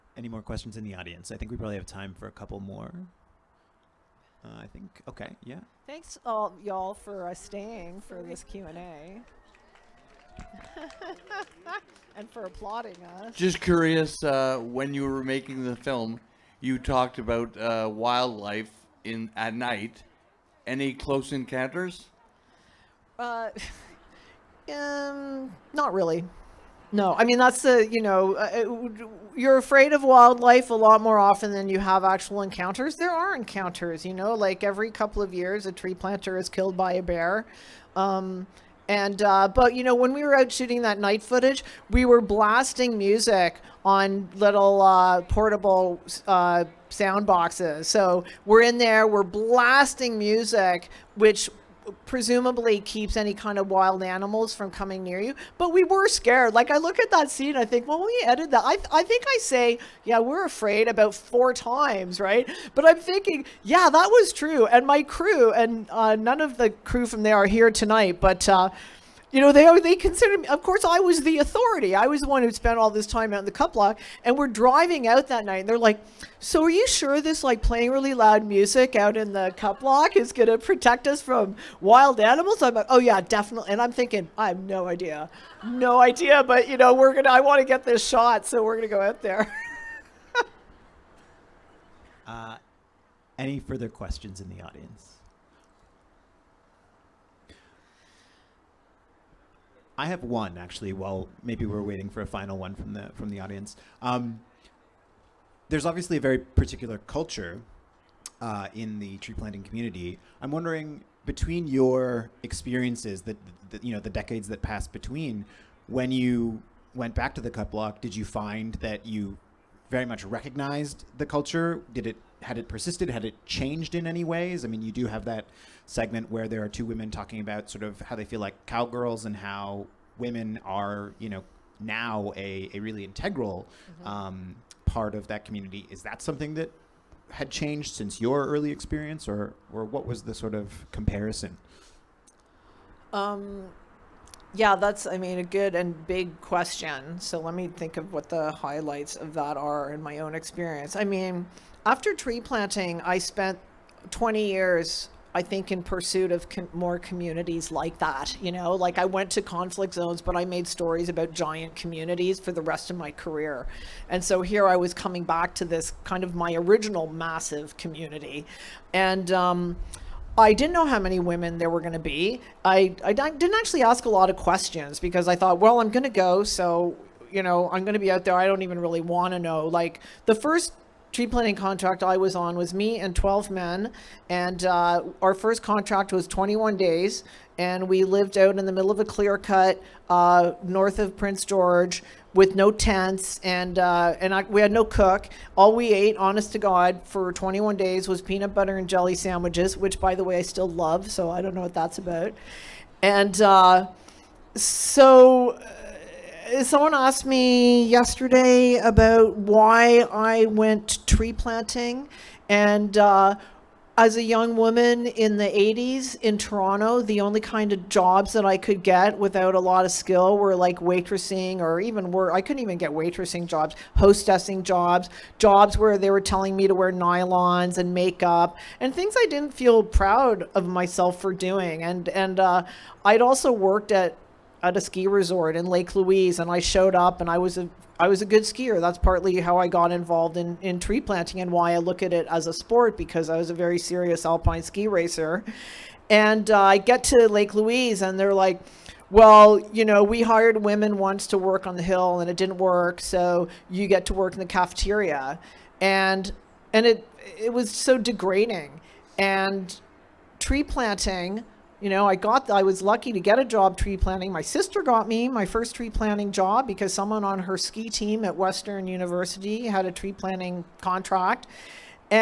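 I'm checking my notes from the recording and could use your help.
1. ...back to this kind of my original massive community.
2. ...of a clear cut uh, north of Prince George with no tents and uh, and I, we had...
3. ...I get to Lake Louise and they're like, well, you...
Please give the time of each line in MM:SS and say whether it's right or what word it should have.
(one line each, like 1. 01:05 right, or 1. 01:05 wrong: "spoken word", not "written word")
1. 02:45 right
2. 03:08 right
3. 04:06 right.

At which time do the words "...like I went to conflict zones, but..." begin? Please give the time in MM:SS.
02:38.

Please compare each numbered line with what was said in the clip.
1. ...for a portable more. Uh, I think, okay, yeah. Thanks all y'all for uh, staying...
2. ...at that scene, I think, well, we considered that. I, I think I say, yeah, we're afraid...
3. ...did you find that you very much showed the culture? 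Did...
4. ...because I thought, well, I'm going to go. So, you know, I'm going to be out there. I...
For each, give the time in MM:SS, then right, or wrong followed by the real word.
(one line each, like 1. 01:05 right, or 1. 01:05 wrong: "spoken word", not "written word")
1. 00:02 wrong: "couple", not "portable"
2. 00:56 wrong: "edited", not "considered"
3. 01:58 wrong: "recognized", not "showed"
4. 02:54 right.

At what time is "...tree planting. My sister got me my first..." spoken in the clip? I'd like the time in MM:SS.
04:23.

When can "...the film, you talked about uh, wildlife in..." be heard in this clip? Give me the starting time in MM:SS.
00:15.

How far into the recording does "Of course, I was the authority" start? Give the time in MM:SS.
01:10.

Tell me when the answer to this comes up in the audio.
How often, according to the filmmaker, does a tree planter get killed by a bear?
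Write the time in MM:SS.
00:34.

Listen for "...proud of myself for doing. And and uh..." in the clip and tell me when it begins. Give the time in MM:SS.
03:49.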